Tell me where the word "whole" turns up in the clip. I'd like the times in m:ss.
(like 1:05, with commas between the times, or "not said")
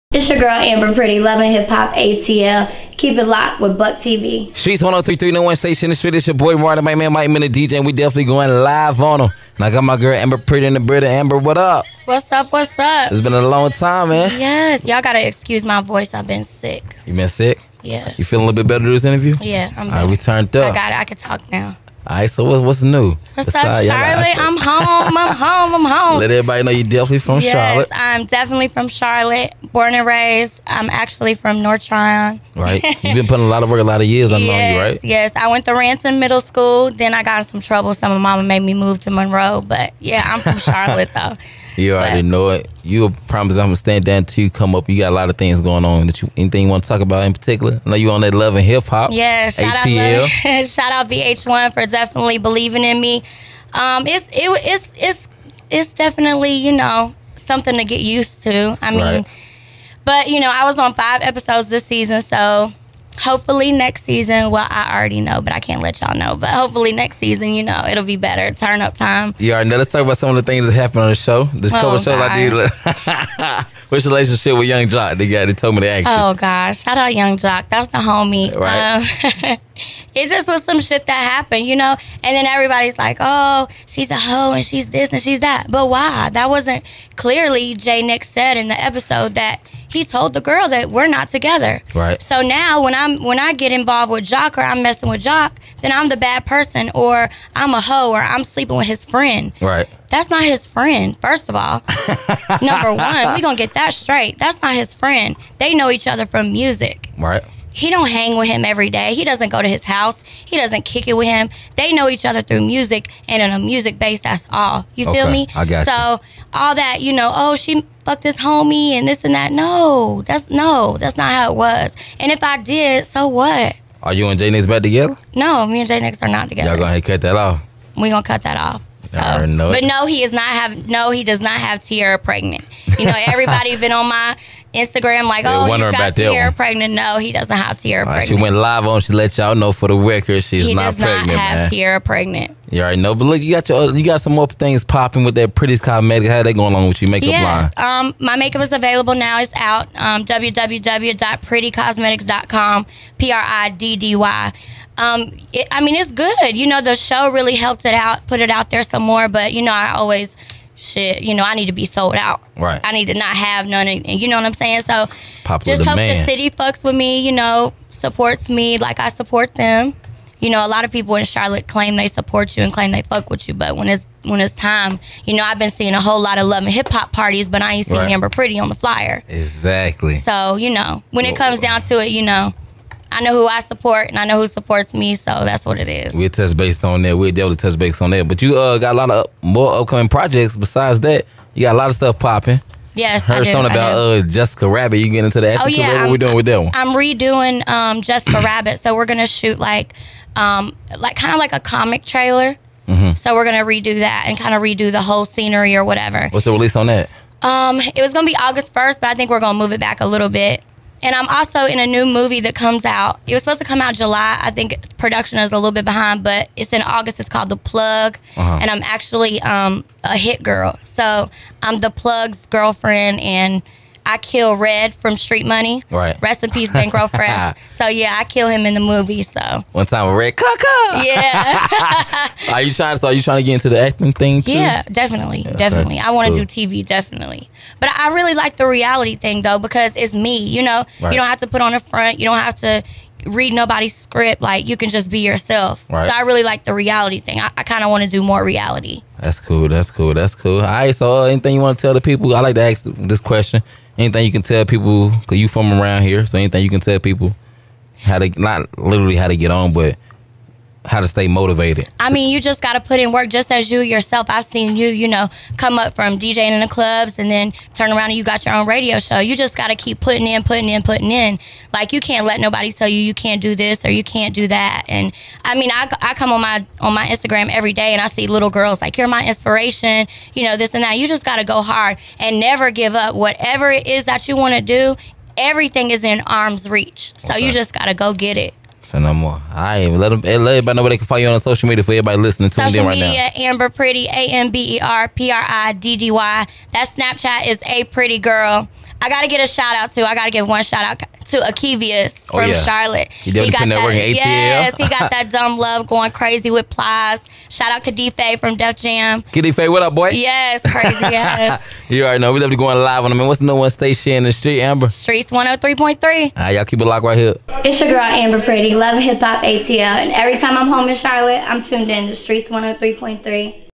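2:56, 3:25.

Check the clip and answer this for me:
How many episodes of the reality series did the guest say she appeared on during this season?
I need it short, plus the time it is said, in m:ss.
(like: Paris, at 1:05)
5, at 1:00.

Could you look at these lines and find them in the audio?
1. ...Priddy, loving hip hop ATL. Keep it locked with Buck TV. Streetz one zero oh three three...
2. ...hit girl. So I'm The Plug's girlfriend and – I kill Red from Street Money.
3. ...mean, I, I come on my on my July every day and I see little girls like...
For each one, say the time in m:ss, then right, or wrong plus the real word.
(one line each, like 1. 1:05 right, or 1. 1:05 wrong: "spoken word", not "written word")
1. 0:00 right
2. 3:40 right
3. 4:35 wrong: "Instagram", not "July".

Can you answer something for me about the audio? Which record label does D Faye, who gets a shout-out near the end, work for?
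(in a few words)
Def Jam.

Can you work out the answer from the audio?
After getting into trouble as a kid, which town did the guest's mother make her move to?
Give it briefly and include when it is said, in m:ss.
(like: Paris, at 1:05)
Monroe, at 0:39.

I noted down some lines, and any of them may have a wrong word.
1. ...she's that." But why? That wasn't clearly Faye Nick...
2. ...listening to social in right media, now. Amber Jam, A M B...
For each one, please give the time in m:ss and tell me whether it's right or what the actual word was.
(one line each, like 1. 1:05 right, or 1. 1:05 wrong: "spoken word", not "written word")
1. 1:25 wrong: "Jay", not "Faye"
2. 4:52 wrong: "Priddy", not "Jam".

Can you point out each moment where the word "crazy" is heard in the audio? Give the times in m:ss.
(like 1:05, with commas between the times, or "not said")
5:06, 5:10.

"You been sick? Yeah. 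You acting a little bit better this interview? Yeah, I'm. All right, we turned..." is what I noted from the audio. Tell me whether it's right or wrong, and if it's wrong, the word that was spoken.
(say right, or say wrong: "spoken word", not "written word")
wrong: "feeling", not "acting".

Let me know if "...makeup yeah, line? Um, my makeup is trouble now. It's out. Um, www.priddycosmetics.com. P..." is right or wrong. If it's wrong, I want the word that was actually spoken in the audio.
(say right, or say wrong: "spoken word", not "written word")
wrong: "available", not "trouble".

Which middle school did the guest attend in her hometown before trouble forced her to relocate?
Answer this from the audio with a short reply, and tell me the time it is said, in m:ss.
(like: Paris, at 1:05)
Ranson Middle School, at 0:35.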